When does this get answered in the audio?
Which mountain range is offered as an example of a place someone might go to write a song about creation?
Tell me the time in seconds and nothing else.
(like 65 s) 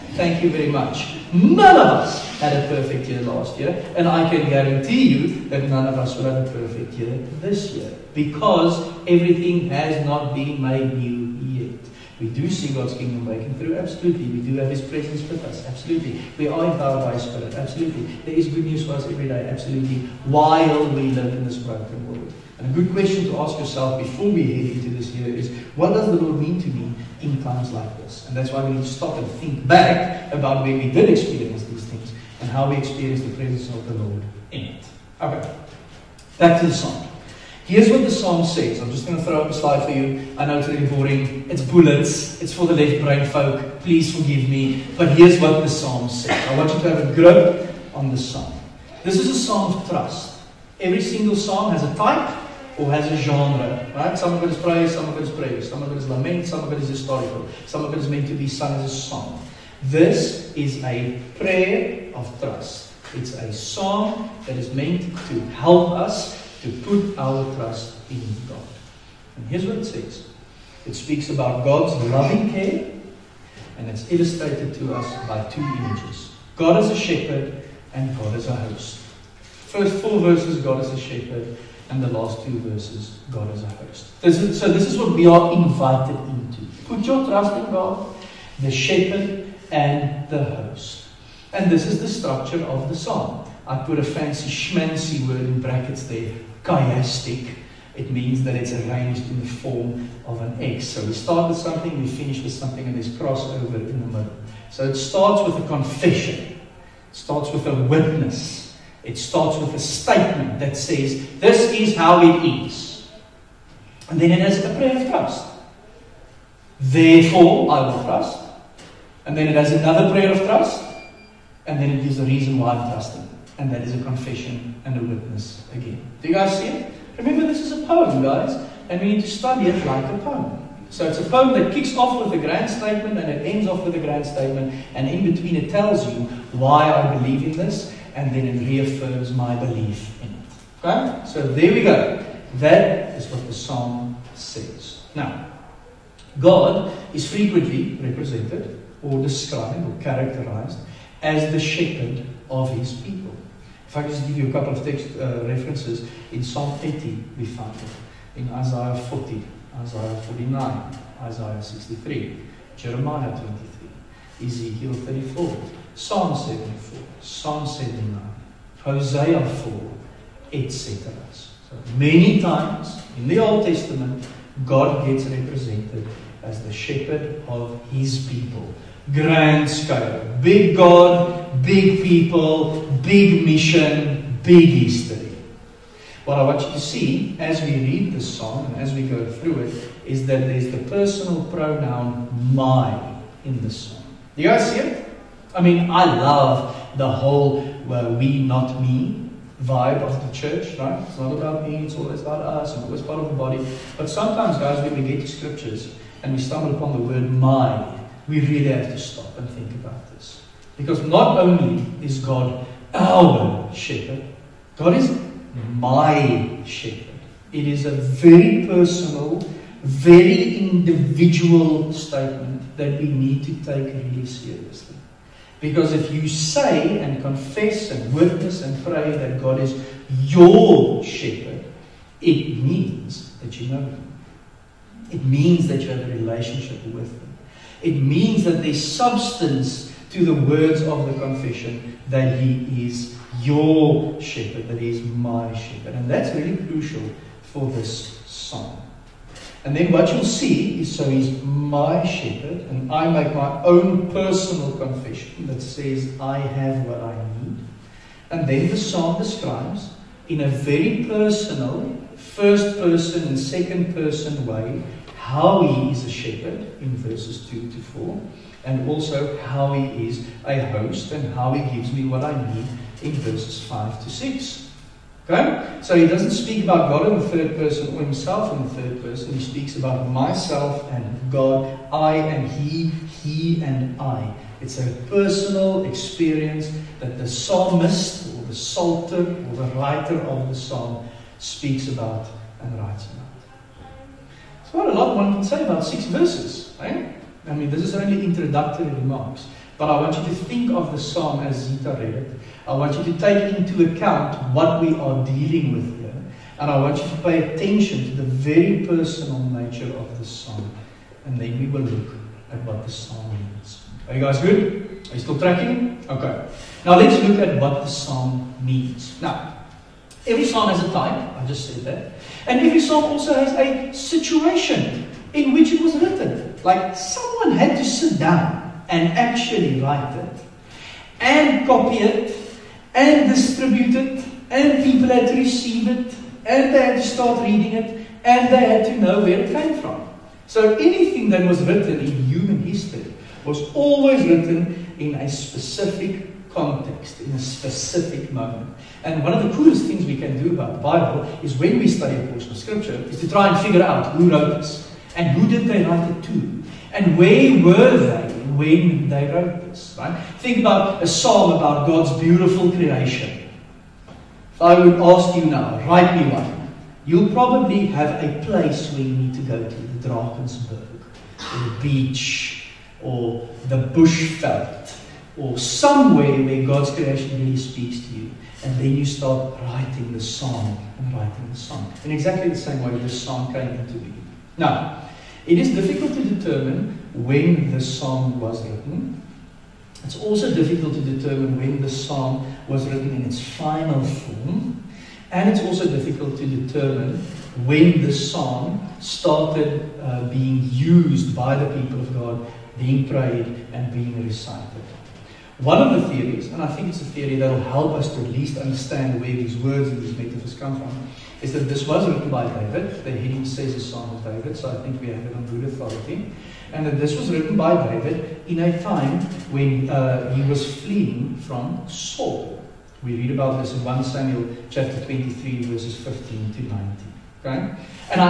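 370 s.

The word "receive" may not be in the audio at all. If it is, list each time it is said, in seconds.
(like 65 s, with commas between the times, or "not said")
335 s.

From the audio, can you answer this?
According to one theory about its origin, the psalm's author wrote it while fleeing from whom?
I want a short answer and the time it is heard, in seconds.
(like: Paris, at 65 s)
Saul, at 421 s.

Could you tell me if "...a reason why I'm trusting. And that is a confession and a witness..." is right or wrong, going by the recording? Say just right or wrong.
right.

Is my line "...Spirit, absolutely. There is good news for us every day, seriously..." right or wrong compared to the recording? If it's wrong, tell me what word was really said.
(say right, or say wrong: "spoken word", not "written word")
wrong: "absolutely", not "seriously".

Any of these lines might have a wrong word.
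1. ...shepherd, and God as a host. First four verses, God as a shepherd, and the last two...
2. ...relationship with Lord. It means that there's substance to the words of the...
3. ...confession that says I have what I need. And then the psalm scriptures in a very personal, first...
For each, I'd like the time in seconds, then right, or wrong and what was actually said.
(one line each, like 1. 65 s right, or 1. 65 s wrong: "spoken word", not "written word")
1. 76 s right
2. 236 s wrong: "Him", not "Lord"
3. 254 s wrong: "describes", not "scriptures".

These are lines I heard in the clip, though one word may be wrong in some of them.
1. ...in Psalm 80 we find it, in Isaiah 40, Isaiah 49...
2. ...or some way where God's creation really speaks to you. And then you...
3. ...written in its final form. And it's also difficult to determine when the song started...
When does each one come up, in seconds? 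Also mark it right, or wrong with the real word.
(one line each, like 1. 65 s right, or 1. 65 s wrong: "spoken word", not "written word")
1. 156 s right
2. 375 s right
3. 392 s right.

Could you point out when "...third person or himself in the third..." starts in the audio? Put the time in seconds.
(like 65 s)
277 s.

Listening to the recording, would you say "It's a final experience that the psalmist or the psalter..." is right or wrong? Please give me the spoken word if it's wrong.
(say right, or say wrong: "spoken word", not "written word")
wrong: "personal", not "final".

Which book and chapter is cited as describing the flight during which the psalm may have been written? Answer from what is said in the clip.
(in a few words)
1 Samuel 23.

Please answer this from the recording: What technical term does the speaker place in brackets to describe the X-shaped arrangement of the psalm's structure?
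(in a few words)
chiastic.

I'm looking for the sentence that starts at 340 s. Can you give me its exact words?
So anything that was written in human history was always written in a specific context, in a specific moment.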